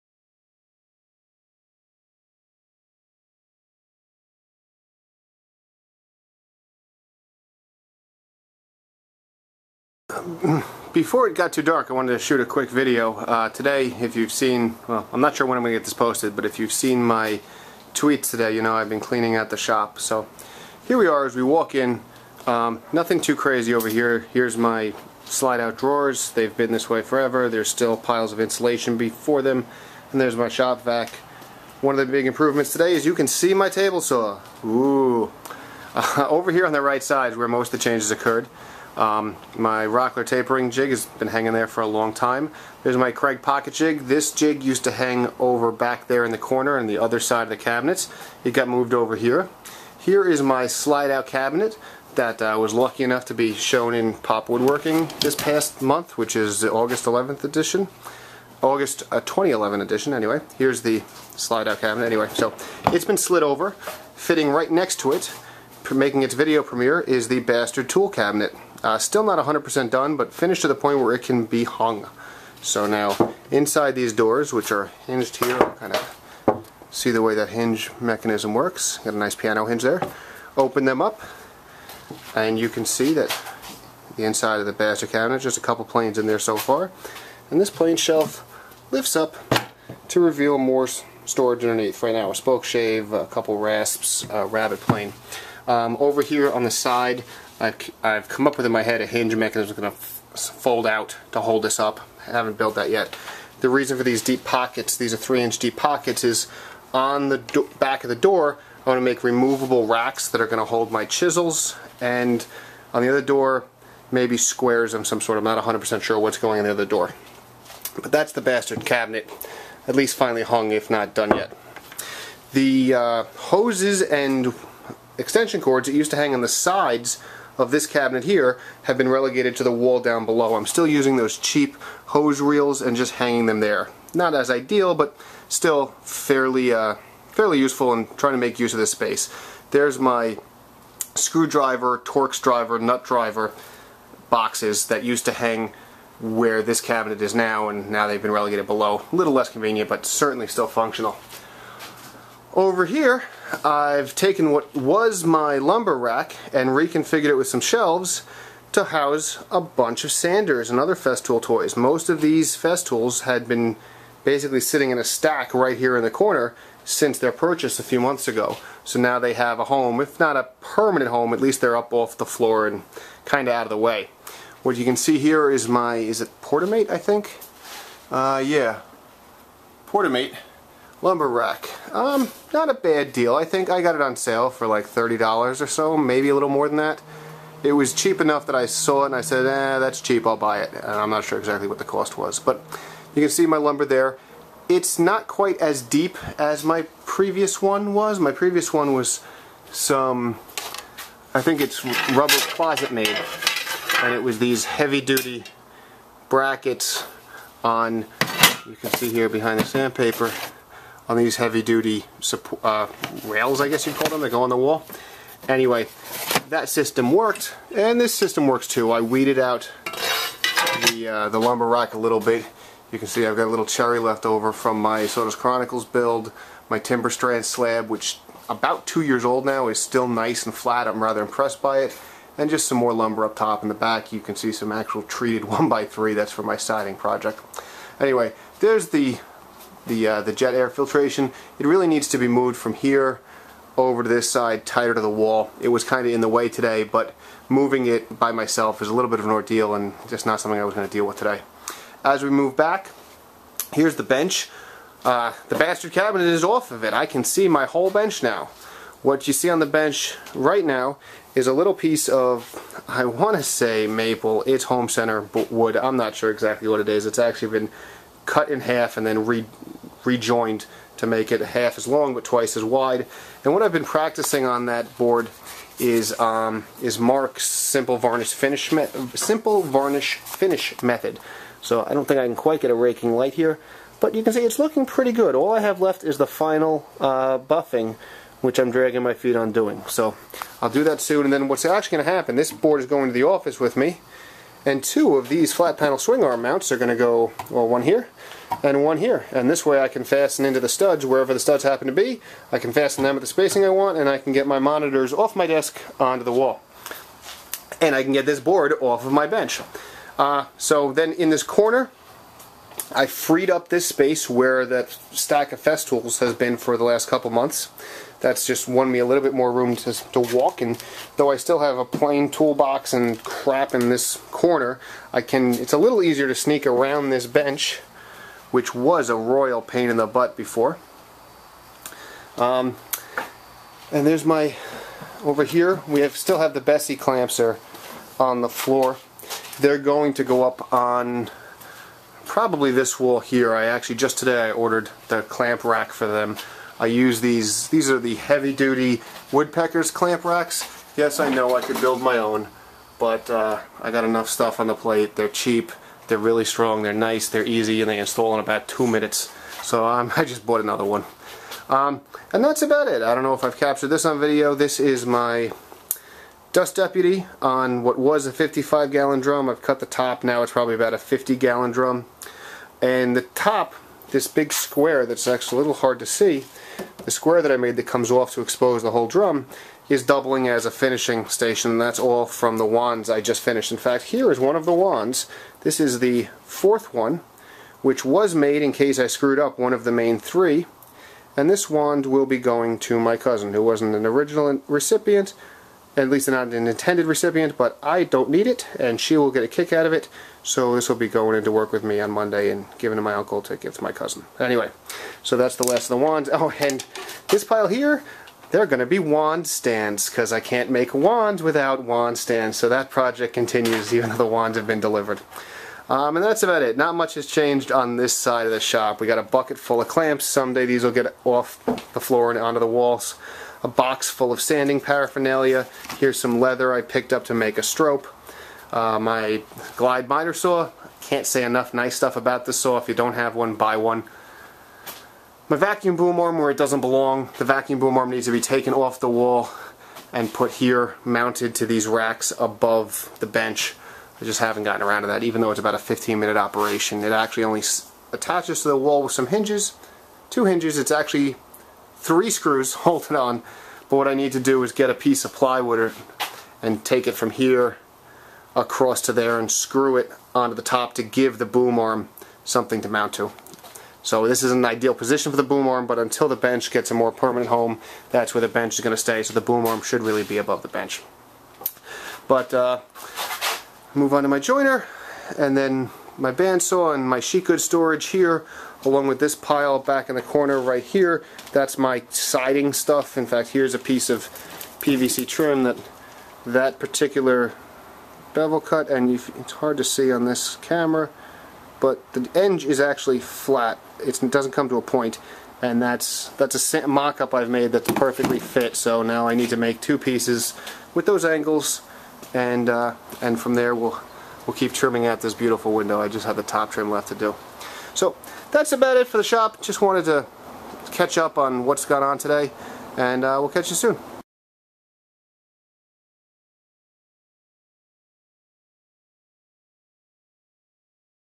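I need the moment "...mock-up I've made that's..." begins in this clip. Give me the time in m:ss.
8:16.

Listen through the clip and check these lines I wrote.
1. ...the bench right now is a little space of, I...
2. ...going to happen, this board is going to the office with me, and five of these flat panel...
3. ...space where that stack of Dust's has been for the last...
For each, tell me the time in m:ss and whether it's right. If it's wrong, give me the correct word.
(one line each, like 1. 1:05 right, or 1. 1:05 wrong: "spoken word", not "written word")
1. 4:19 wrong: "piece", not "space"
2. 4:51 wrong: "two", not "five"
3. 5:13 wrong: "Festool", not "Dust".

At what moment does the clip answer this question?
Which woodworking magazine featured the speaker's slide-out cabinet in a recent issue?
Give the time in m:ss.
0:54.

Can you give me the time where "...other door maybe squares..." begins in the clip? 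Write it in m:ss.
1:53.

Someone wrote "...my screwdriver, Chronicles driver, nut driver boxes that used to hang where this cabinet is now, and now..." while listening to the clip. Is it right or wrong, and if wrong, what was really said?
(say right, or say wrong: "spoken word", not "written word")
wrong: "Torx", not "Chronicles".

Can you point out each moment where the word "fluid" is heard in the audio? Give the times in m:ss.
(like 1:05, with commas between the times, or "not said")
not said.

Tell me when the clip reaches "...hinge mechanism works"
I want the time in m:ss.
1:17.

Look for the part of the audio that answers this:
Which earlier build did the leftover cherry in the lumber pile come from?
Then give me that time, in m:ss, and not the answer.
3:45.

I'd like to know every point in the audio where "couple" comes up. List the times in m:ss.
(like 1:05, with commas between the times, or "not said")
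1:25, 1:33, 5:17.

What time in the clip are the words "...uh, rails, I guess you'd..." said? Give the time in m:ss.
3:32.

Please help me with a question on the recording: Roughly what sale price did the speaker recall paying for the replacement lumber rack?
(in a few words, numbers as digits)
$30.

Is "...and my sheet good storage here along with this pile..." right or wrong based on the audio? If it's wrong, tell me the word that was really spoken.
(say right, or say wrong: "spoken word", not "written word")
right.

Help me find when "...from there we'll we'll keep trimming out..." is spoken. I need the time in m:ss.
8:23.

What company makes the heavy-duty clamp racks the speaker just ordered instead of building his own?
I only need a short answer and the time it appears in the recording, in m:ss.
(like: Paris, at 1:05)
Woodpeckers, at 5:49.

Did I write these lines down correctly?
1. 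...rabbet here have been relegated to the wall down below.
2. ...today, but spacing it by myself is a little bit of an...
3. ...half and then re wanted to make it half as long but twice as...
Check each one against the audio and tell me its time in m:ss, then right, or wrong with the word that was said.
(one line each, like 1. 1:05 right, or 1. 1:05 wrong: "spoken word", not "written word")
1. 2:07 wrong: "cabinet", not "rabbet"
2. 4:06 wrong: "moving", not "spacing"
3. 4:28 wrong: "rejoined", not "wanted".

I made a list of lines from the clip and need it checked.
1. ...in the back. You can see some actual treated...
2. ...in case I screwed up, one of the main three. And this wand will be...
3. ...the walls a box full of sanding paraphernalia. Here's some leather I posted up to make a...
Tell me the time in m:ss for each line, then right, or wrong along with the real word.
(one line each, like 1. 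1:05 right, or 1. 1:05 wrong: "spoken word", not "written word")
1. 3:53 right
2. 6:28 right
3. 7:02 wrong: "picked", not "posted".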